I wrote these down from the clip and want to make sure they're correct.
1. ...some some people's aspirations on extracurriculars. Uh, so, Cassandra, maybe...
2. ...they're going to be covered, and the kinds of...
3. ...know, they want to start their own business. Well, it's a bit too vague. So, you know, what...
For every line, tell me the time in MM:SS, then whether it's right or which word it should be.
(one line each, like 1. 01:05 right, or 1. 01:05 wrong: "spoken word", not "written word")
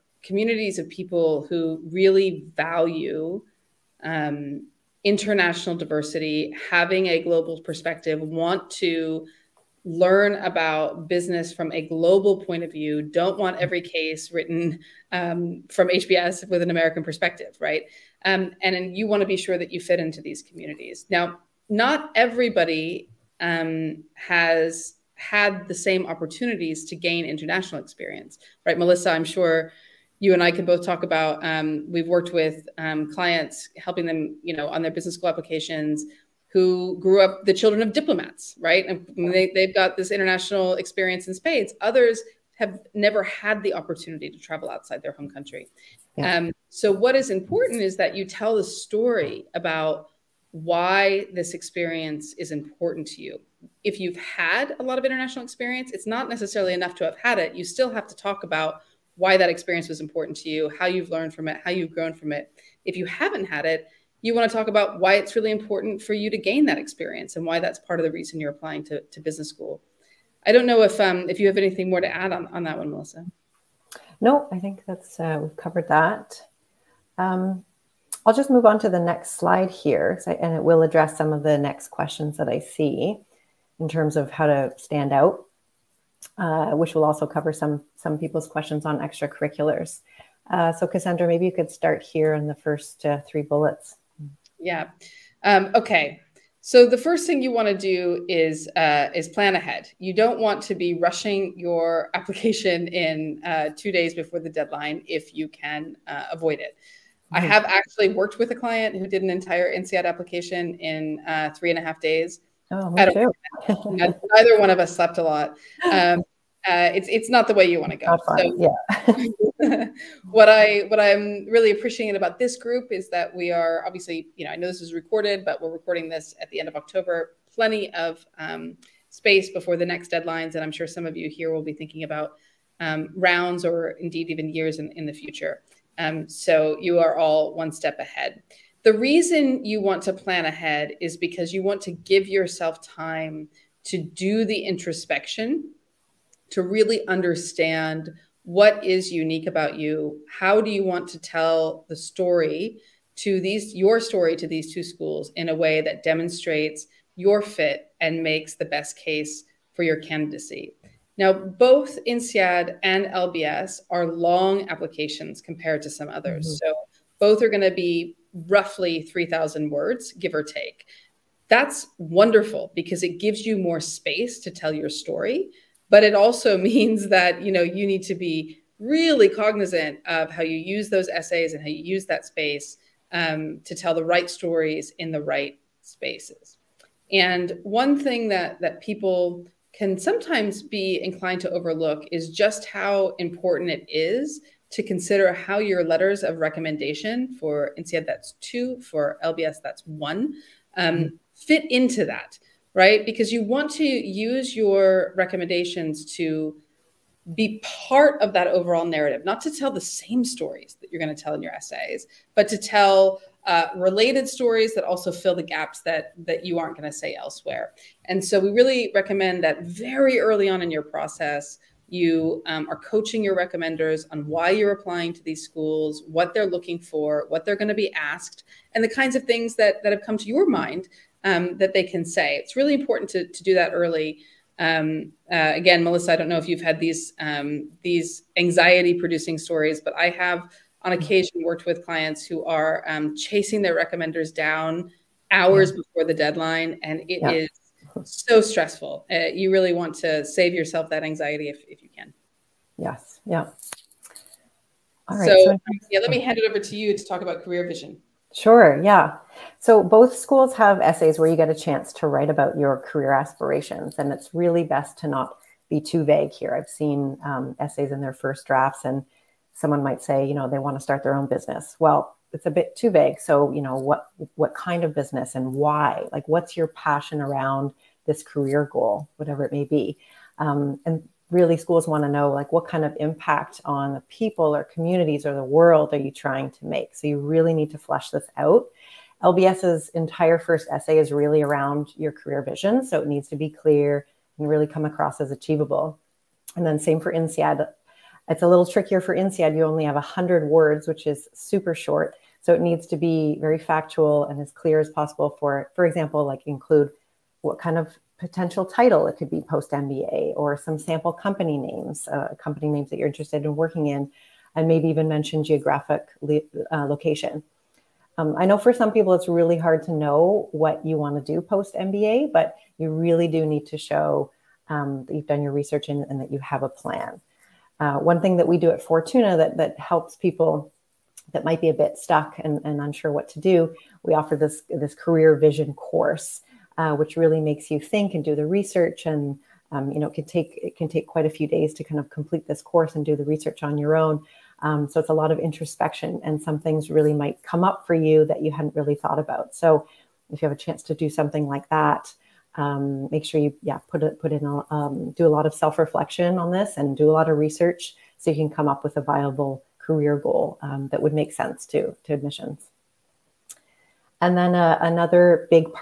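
1. 01:27 wrong: "questions", not "aspirations"
2. 03:47 wrong: "asked", not "covered"
3. 04:30 right.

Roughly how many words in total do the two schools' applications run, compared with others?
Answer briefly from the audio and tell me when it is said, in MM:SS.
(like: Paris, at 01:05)
3000, at 02:49.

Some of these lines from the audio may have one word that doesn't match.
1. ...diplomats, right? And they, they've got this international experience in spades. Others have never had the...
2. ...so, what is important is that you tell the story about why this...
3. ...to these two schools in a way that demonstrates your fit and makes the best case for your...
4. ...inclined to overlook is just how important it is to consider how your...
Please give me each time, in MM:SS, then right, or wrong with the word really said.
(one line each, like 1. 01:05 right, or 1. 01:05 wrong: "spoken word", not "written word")
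1. 00:37 right
2. 00:46 right
3. 02:34 right
4. 03:11 right.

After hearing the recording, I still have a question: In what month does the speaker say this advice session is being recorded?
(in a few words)
October.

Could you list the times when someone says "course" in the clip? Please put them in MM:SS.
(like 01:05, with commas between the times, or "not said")
05:35, 05:42.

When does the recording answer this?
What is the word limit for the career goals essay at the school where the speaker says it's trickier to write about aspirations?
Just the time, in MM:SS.
04:59.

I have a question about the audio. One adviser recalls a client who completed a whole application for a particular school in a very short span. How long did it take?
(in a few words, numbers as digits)
3.5 days.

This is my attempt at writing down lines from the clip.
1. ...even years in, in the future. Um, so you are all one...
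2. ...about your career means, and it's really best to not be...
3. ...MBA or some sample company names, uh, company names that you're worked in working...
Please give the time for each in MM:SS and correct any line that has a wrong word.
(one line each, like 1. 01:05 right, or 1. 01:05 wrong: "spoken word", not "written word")
1. 02:14 right
2. 04:22 wrong: "aspirations", not "means"
3. 05:09 wrong: "interested", not "worked".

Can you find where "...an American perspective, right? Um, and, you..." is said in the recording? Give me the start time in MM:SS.
00:16.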